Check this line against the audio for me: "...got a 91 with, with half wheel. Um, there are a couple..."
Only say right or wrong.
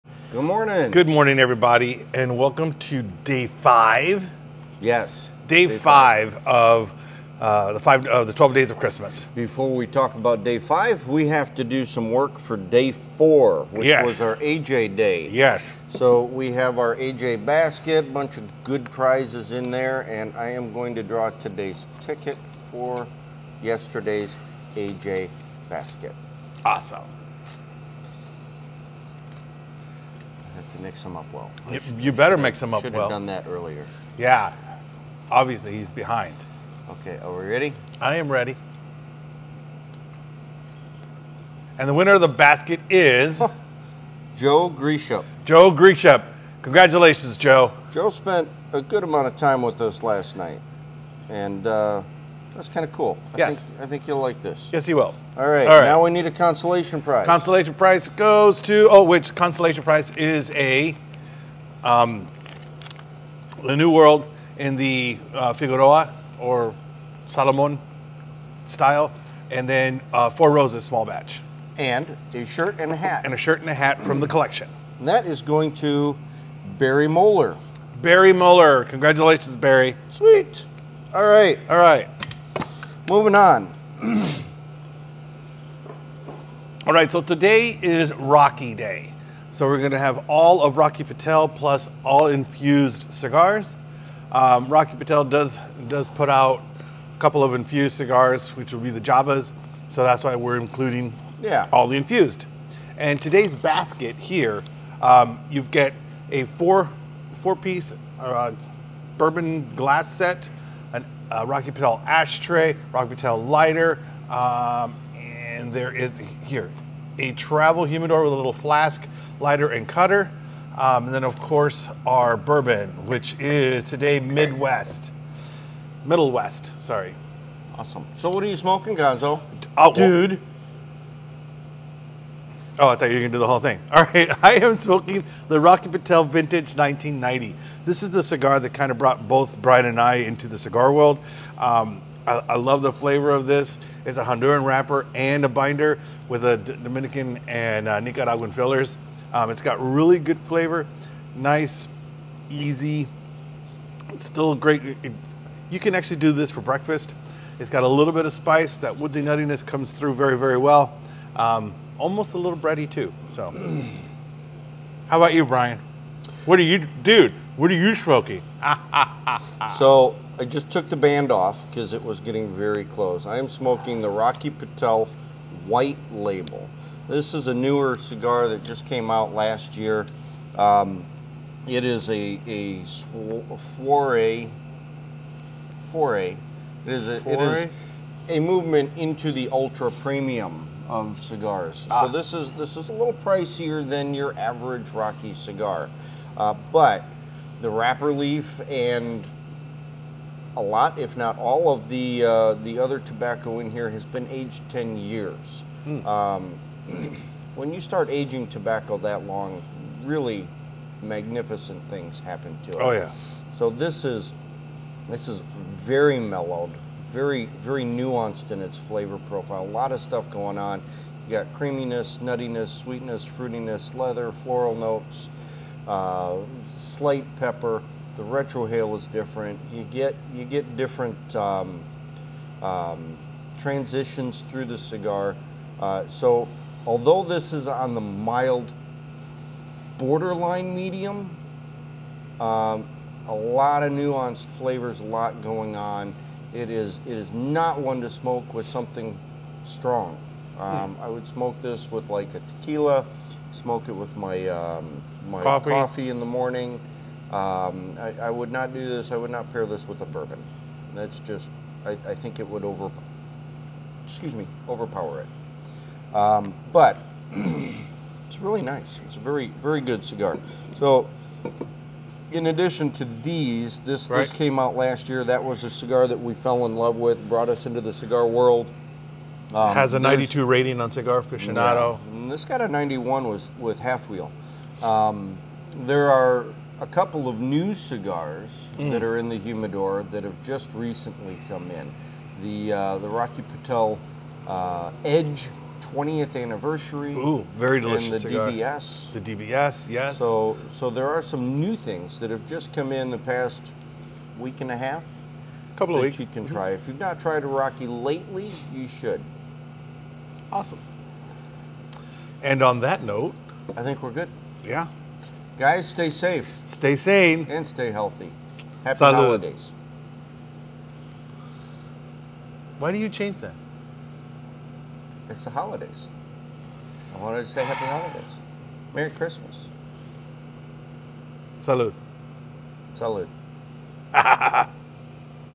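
right.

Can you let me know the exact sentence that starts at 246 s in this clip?
It is, it is not one to smoke with something strong.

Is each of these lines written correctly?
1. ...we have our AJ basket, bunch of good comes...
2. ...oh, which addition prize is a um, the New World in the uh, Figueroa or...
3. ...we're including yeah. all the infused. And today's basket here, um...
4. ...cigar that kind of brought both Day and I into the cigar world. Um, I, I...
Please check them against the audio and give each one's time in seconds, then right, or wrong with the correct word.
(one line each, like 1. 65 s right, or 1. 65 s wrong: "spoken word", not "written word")
1. 16 s wrong: "prizes", not "comes"
2. 58 s wrong: "consolation", not "addition"
3. 100 s right
4. 138 s wrong: "Brian", not "Day".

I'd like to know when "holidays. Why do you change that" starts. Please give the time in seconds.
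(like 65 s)
319 s.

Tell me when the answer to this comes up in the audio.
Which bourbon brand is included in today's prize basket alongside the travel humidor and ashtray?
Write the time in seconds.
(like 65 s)
126 s.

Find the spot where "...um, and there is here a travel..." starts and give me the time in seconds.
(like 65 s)
114 s.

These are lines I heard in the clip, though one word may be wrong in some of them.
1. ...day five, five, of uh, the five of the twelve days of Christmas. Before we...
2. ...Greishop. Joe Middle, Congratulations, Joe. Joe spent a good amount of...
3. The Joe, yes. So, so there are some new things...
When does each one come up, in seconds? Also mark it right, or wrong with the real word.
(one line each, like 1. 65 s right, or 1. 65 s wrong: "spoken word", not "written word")
1. 5 s right
2. 44 s wrong: "Greishop", not "Middle"
3. 299 s wrong: "DBS", not "Joe".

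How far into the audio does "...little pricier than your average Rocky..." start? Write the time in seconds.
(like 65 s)
192 s.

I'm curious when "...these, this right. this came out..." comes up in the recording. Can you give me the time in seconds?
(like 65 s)
273 s.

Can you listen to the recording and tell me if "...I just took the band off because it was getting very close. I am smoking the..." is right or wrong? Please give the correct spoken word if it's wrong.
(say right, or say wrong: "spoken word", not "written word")
right.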